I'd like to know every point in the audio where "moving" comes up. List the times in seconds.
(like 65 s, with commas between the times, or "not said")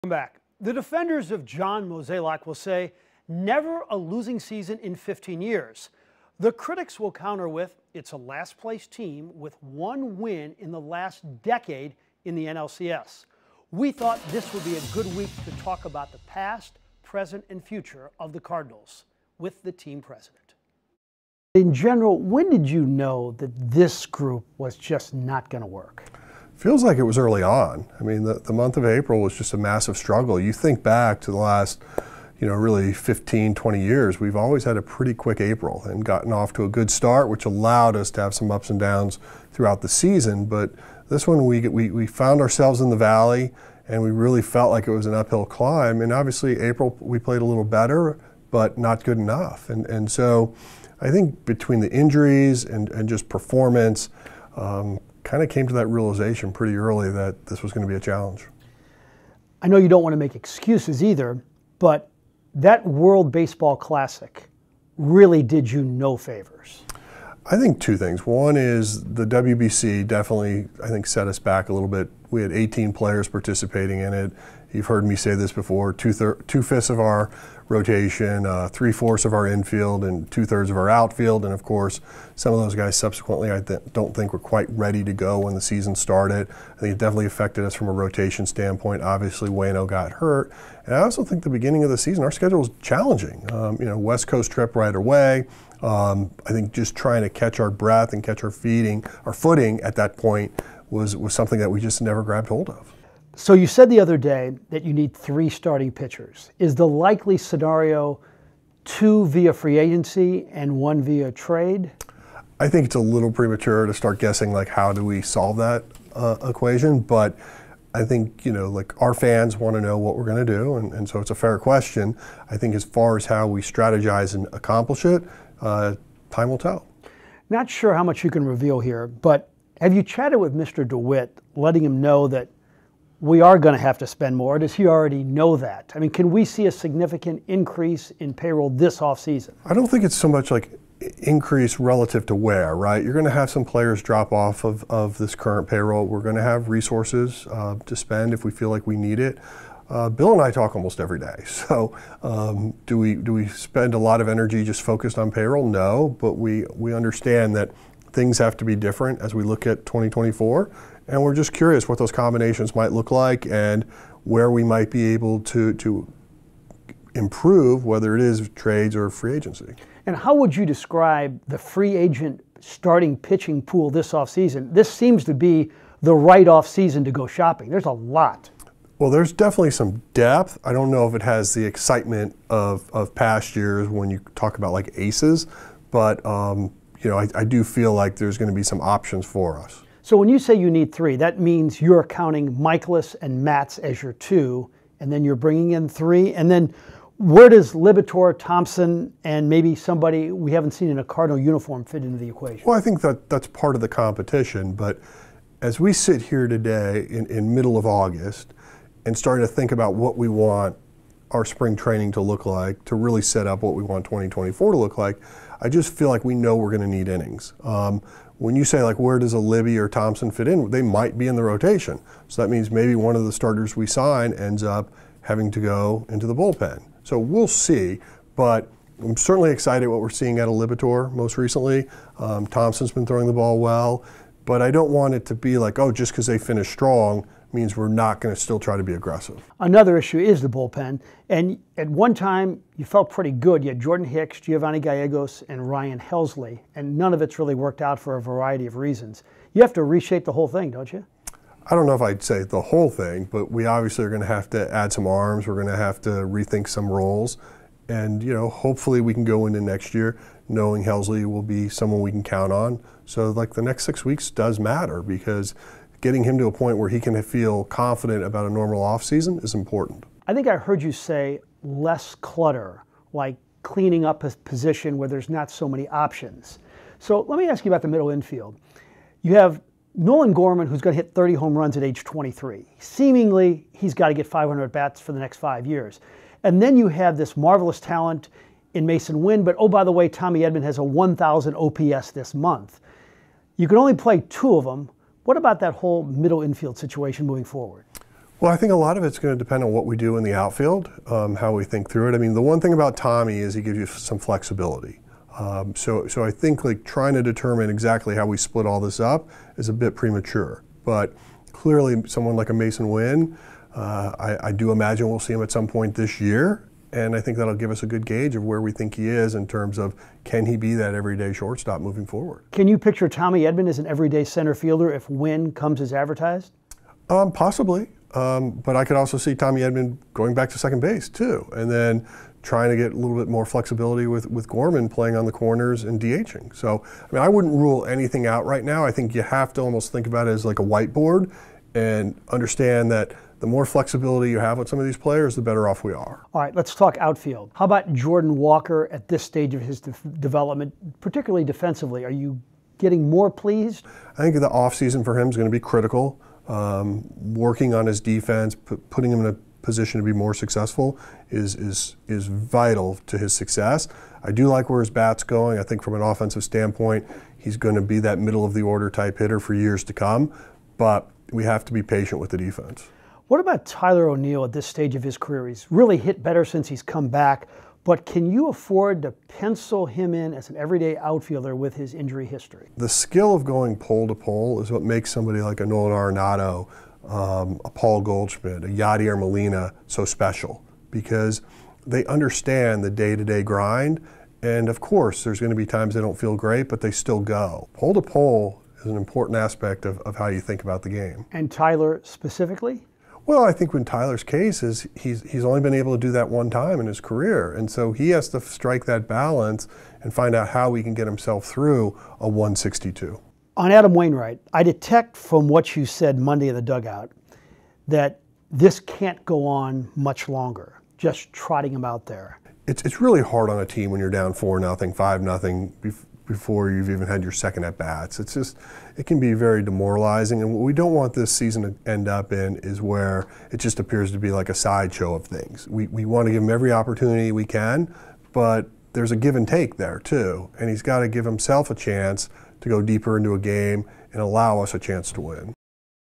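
297 s, 321 s.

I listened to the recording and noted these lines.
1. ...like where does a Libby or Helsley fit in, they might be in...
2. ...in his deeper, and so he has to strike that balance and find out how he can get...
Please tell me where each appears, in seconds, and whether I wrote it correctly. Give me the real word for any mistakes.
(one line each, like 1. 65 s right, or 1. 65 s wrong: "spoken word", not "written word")
1. 218 s wrong: "Thompson", not "Helsley"
2. 406 s wrong: "career", not "deeper".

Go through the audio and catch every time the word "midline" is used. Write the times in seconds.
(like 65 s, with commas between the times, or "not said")
not said.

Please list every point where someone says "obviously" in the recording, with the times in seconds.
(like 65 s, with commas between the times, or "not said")
46 s, 89 s, 253 s.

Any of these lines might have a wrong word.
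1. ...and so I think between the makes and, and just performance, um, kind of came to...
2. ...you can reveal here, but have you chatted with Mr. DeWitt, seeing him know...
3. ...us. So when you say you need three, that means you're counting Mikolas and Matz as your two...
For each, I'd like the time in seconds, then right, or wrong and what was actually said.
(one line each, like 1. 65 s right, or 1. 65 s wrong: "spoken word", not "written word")
1. 49 s wrong: "injuries", not "makes"
2. 128 s wrong: "letting", not "seeing"
3. 189 s right.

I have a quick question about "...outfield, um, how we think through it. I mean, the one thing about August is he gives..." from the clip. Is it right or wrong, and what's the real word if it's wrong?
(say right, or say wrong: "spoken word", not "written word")
wrong: "Tommy", not "August".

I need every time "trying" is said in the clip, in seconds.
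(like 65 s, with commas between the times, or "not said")
96 s, 306 s, 332 s.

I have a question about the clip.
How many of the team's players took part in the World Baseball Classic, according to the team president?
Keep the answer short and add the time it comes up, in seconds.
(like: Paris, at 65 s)
18, at 72 s.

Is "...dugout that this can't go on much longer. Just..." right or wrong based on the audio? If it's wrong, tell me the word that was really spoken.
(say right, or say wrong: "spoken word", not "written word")
right.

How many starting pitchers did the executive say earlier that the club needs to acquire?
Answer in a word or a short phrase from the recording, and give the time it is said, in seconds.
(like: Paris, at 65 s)
3, at 105 s.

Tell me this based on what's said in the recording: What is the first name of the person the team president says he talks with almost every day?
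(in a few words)
Bill.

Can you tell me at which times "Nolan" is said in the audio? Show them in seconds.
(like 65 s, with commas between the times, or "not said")
279 s, 385 s.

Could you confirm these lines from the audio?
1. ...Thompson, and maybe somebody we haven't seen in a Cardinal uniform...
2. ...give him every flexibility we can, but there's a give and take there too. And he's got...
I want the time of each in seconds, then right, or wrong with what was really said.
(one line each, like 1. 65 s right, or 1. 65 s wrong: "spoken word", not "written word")
1. 198 s right
2. 436 s wrong: "opportunity", not "flexibility".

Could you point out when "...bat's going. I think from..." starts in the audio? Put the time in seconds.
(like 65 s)
364 s.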